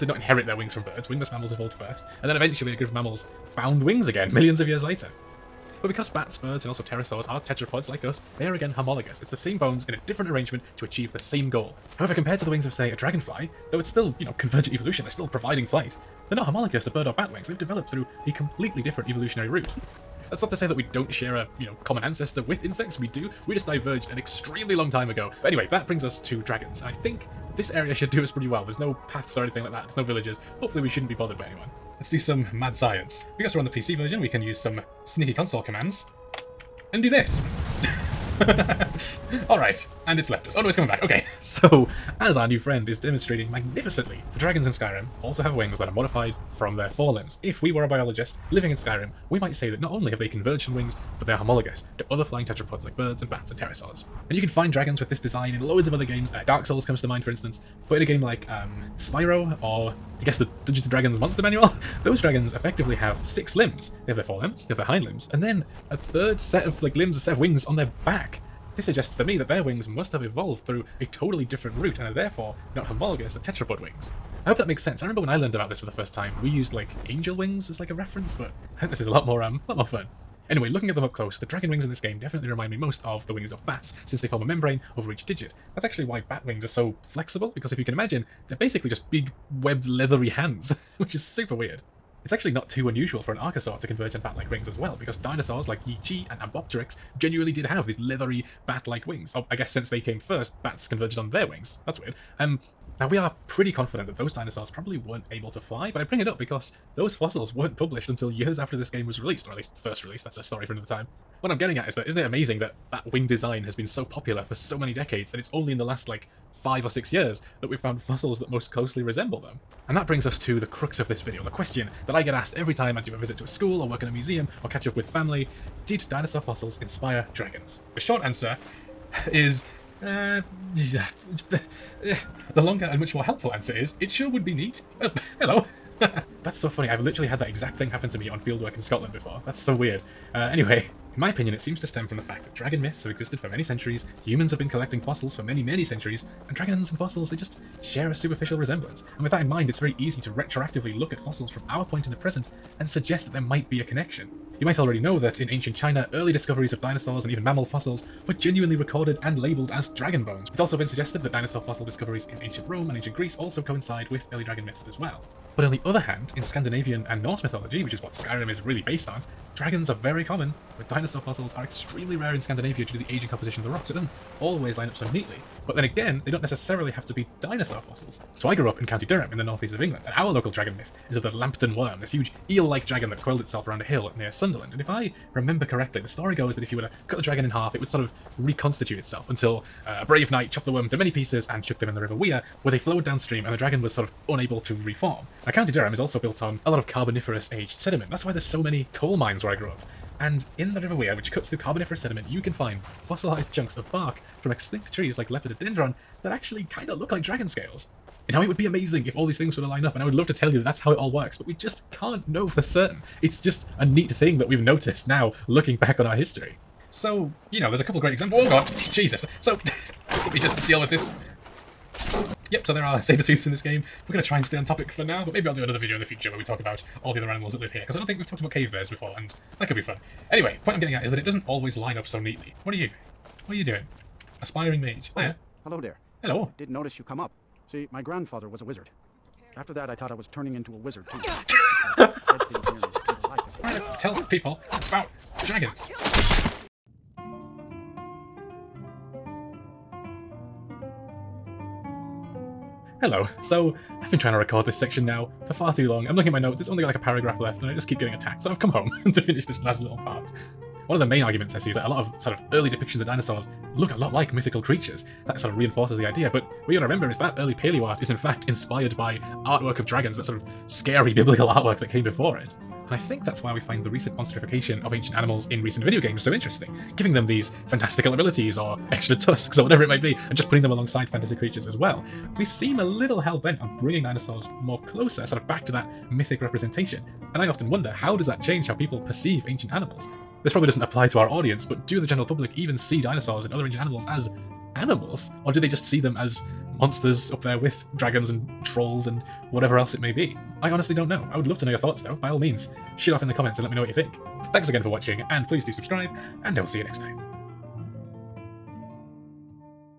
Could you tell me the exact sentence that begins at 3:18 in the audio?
That's why there's so many coal mines where I grew up.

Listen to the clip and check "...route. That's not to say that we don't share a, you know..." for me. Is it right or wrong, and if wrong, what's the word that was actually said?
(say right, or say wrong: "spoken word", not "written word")
right.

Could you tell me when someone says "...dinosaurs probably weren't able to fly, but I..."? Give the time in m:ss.
1:44.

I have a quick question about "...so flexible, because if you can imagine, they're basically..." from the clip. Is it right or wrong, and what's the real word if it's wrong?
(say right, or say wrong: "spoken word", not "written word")
right.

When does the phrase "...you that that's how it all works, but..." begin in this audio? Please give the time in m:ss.
3:30.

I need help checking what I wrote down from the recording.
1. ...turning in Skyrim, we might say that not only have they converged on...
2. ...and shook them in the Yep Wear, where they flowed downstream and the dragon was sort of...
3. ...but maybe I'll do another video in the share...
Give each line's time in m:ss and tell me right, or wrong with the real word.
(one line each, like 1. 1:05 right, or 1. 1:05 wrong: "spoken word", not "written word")
1. 0:48 wrong: "living", not "turning"
2. 3:11 wrong: "River", not "Yep"
3. 3:45 wrong: "future", not "share".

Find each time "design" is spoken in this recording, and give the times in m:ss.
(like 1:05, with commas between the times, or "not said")
0:55, 1:53.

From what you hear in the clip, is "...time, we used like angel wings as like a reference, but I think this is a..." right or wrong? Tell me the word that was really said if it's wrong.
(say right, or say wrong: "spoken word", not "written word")
right.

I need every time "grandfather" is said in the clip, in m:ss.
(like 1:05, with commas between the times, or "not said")
3:58.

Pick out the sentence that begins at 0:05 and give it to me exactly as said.
But because bats, birds, and also pterosaurs are tetrapods like us, they are again homologous.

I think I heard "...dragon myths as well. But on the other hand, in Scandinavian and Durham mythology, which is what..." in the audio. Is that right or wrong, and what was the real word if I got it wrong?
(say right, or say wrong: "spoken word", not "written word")
wrong: "Norse", not "Durham".